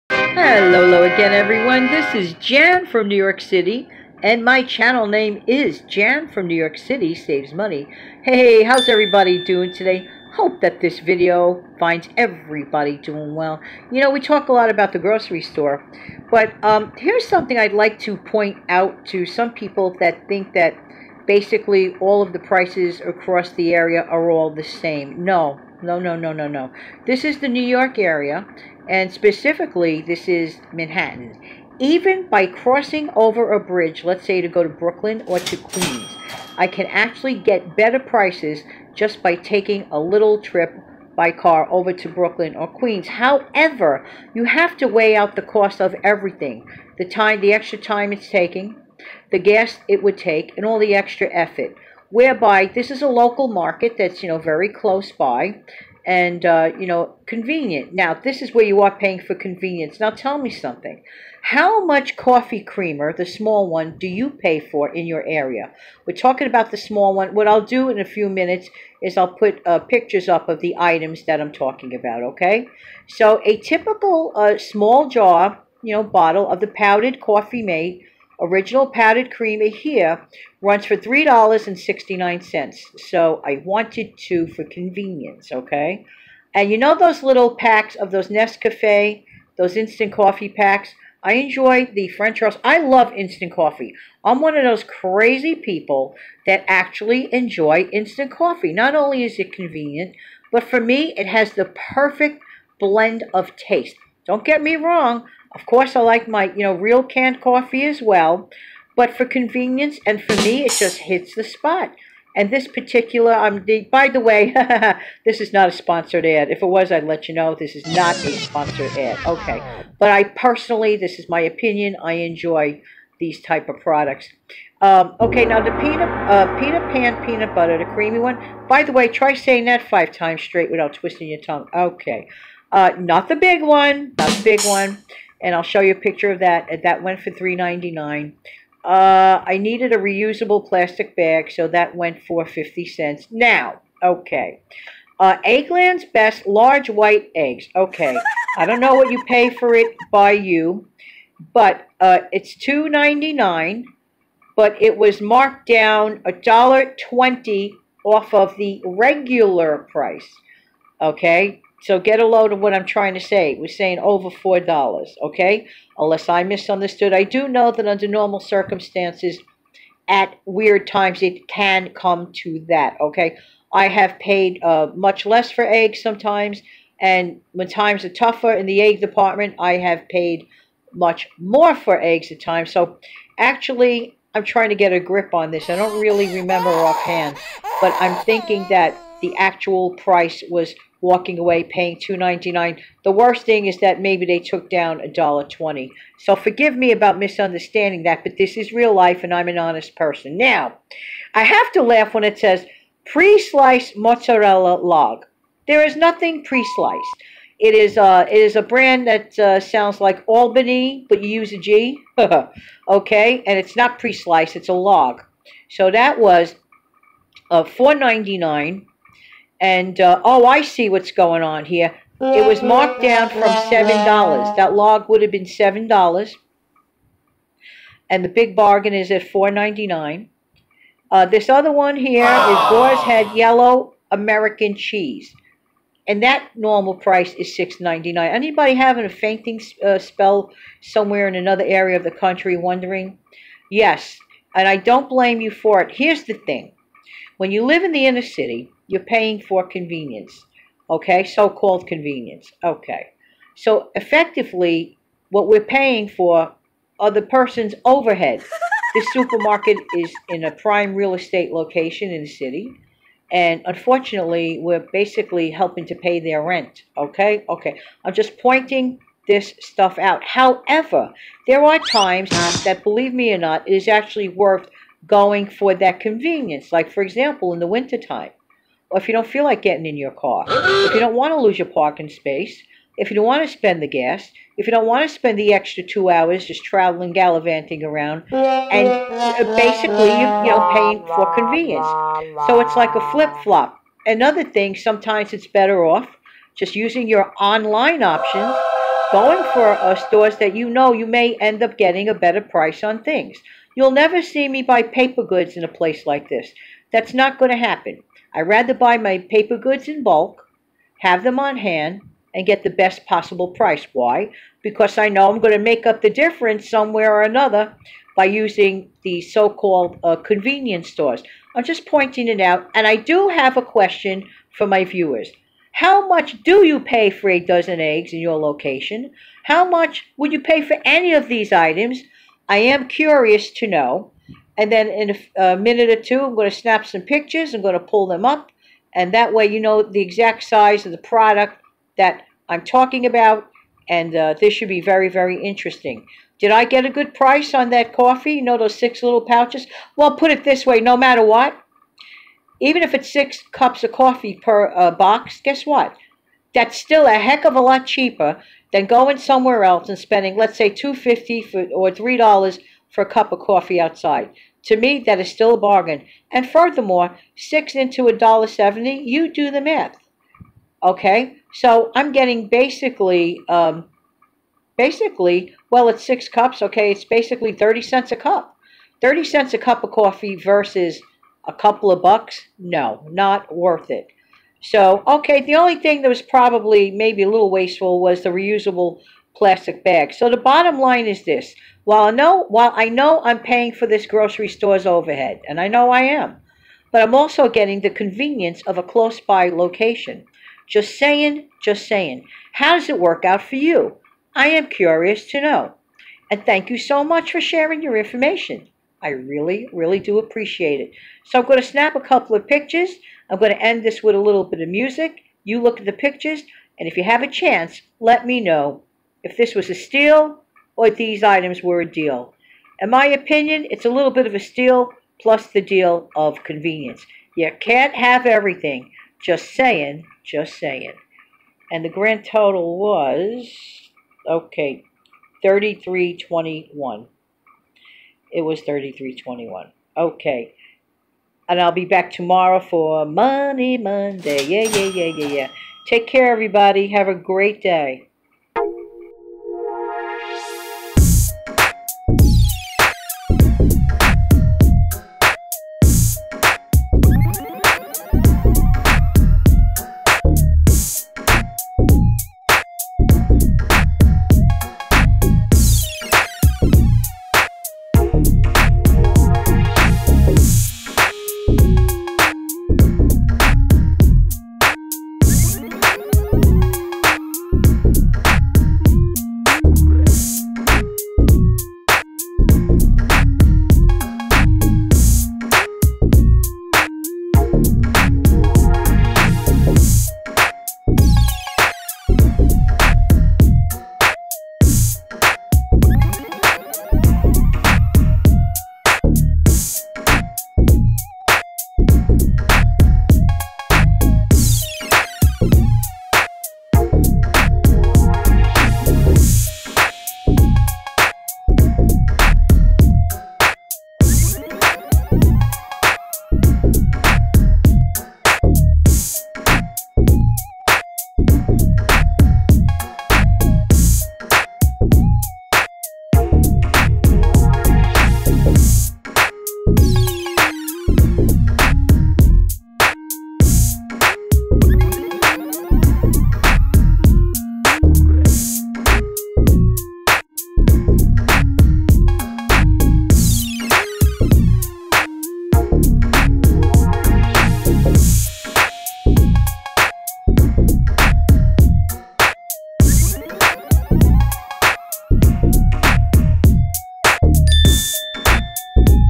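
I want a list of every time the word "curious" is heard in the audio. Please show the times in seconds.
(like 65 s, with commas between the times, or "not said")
332 s, 404 s.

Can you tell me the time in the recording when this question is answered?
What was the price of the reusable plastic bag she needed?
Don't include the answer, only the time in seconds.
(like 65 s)
142 s.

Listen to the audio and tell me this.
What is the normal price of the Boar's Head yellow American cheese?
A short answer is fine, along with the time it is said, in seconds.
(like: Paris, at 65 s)
$6.99, at 237 s.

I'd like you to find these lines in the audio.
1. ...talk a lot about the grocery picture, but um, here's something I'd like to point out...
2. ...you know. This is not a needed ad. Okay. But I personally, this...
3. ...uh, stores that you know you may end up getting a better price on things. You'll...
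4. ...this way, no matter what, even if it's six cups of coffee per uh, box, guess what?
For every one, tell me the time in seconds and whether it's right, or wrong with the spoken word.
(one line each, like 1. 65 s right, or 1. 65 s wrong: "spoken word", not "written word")
1. 14 s wrong: "store", not "picture"
2. 117 s wrong: "sponsored", not "needed"
3. 299 s right
4. 350 s right.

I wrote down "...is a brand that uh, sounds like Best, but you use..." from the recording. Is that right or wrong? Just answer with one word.
wrong.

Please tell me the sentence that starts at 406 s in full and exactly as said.
And thank you so much for sharing your information.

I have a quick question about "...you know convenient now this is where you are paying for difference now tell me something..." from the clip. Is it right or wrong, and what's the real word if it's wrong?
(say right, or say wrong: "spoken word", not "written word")
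wrong: "convenience", not "difference".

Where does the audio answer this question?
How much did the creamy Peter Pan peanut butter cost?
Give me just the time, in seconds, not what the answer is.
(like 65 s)
137 s.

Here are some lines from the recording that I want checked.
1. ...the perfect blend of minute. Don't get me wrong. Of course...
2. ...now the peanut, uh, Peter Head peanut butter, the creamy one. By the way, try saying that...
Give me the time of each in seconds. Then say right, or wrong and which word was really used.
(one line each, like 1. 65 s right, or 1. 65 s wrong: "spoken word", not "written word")
1. 101 s wrong: "taste", not "minute"
2. 125 s wrong: "Pan", not "Head".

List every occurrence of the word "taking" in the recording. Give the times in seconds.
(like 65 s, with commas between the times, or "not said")
39 s, 48 s.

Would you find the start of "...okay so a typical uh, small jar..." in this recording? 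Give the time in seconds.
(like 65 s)
72 s.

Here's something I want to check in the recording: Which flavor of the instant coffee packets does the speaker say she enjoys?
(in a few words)
French roast.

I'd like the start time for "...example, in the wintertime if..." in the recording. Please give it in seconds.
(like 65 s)
277 s.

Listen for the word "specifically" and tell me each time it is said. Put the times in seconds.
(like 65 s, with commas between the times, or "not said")
29 s.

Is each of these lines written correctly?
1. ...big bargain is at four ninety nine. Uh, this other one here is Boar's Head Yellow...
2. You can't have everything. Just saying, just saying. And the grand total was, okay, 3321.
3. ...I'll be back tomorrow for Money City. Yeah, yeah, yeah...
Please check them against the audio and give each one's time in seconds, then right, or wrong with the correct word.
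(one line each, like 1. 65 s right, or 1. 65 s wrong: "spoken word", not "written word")
1. 228 s right
2. 427 s right
3. 441 s wrong: "Monday", not "City".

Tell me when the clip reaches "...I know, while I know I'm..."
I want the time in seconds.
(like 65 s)
392 s.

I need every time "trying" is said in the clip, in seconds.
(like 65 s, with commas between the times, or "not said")
162 s, 184 s.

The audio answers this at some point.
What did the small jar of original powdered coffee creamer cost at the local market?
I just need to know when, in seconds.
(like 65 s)
80 s.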